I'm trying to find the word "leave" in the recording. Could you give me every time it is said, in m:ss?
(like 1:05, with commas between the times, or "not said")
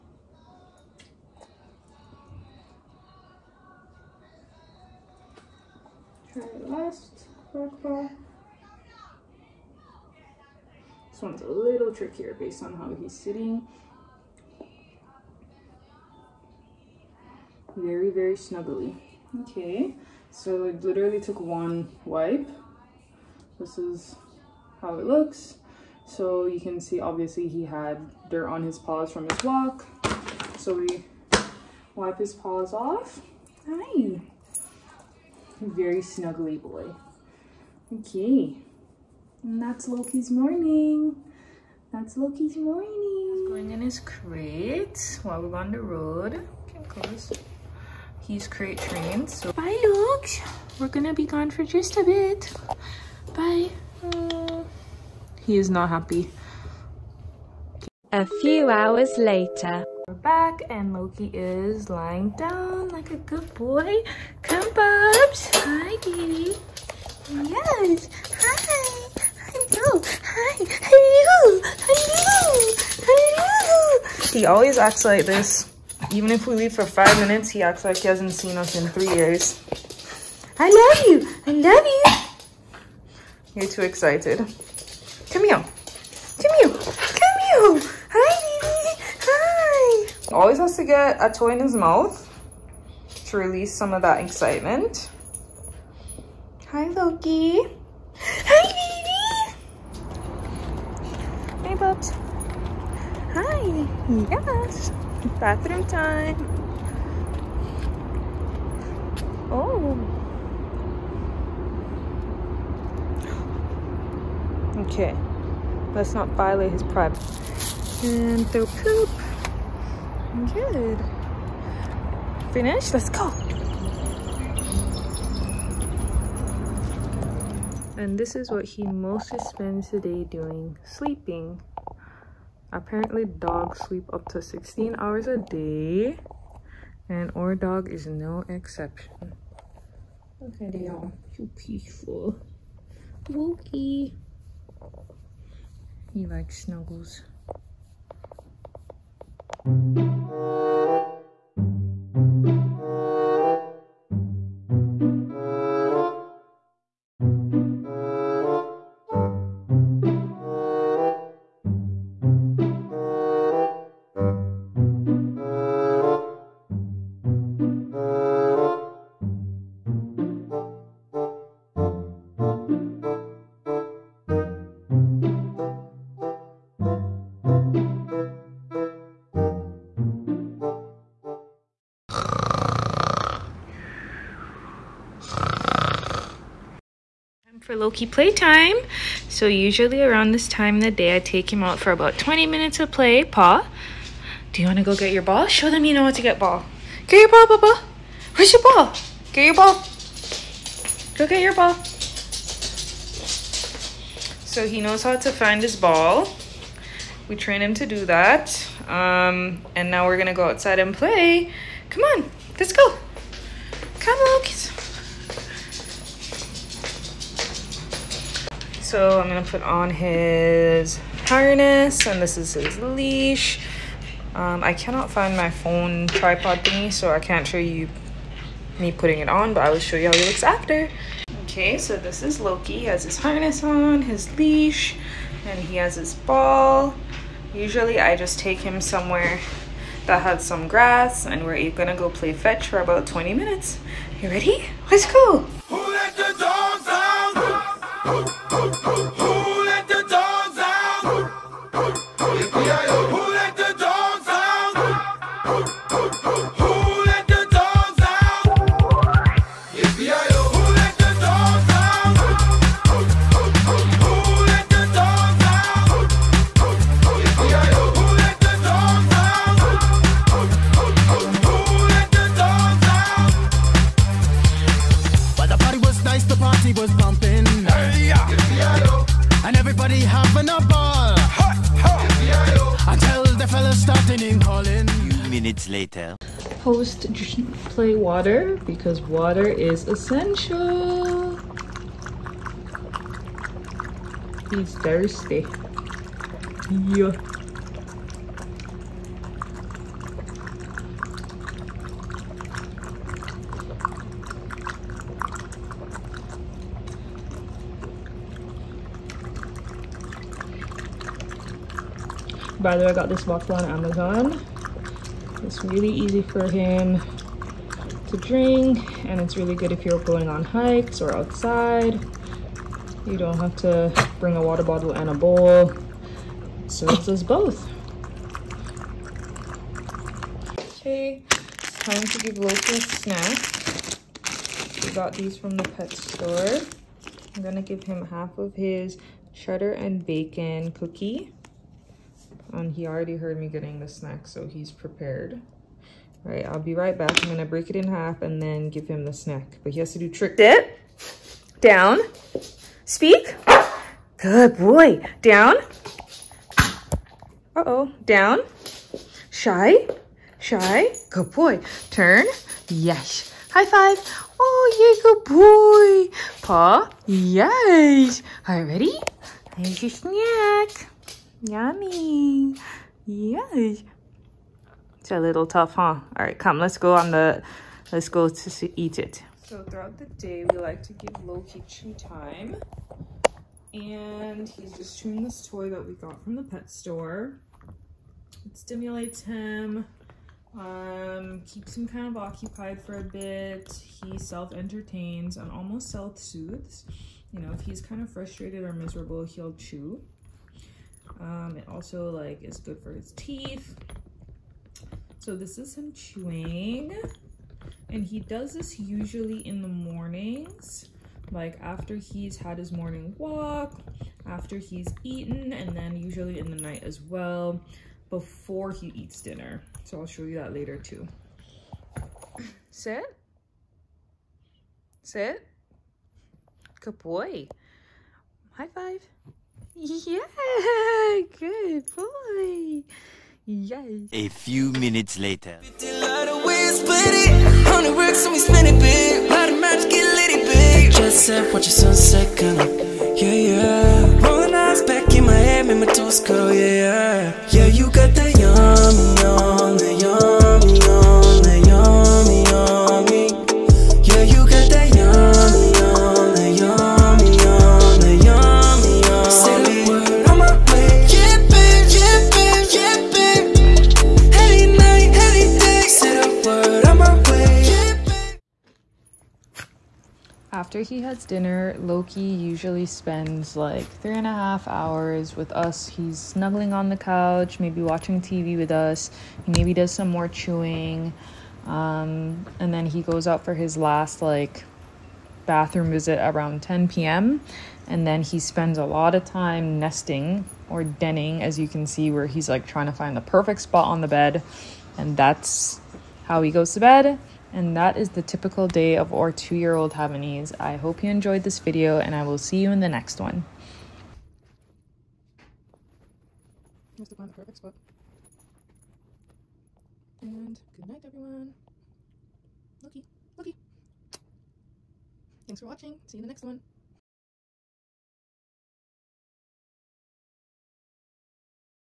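1:16.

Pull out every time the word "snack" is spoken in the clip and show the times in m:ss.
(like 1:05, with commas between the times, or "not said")
5:32, 5:43, 5:49, 6:09.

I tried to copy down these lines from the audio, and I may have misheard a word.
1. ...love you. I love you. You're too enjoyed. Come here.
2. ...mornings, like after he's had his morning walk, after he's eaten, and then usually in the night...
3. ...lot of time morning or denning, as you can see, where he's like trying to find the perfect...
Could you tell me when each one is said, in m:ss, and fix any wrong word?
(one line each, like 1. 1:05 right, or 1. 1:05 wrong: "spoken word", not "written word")
1. 1:20 wrong: "excited", not "enjoyed"
2. 6:49 right
3. 8:08 wrong: "nesting", not "morning".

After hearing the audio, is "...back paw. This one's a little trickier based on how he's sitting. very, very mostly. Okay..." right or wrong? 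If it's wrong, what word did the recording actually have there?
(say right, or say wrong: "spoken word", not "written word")
wrong: "snuggly", not "mostly".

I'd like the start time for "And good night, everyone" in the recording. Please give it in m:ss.
8:30.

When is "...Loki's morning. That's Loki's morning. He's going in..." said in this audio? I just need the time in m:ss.
0:39.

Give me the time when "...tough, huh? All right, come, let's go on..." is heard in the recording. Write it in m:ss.
6:15.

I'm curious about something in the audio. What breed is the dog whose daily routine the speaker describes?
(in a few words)
Havanese.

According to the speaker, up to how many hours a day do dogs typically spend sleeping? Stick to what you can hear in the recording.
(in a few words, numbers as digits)
16 hours.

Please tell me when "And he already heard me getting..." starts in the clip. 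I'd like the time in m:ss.
5:42.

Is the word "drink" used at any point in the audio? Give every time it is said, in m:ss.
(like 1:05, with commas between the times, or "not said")
5:18.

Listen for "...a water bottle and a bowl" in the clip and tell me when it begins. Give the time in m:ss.
5:24.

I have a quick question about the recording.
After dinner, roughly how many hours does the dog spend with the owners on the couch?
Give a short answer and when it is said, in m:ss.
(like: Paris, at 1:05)
3.5 hours, at 7:53.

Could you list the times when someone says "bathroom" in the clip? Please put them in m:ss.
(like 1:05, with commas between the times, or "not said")
1:45, 8:05.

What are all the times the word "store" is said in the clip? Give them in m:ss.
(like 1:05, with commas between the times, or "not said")
5:35, 6:26.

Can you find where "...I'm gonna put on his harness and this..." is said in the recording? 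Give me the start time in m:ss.
3:39.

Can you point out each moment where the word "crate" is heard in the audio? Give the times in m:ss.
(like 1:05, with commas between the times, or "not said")
0:43, 0:48.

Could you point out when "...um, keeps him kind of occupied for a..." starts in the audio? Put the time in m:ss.
6:30.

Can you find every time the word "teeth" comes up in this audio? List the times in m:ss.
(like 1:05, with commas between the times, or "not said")
6:43.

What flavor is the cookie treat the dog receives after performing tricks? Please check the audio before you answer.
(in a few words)
Cheddar and bacon.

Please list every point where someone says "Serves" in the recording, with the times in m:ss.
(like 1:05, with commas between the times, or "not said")
5:26.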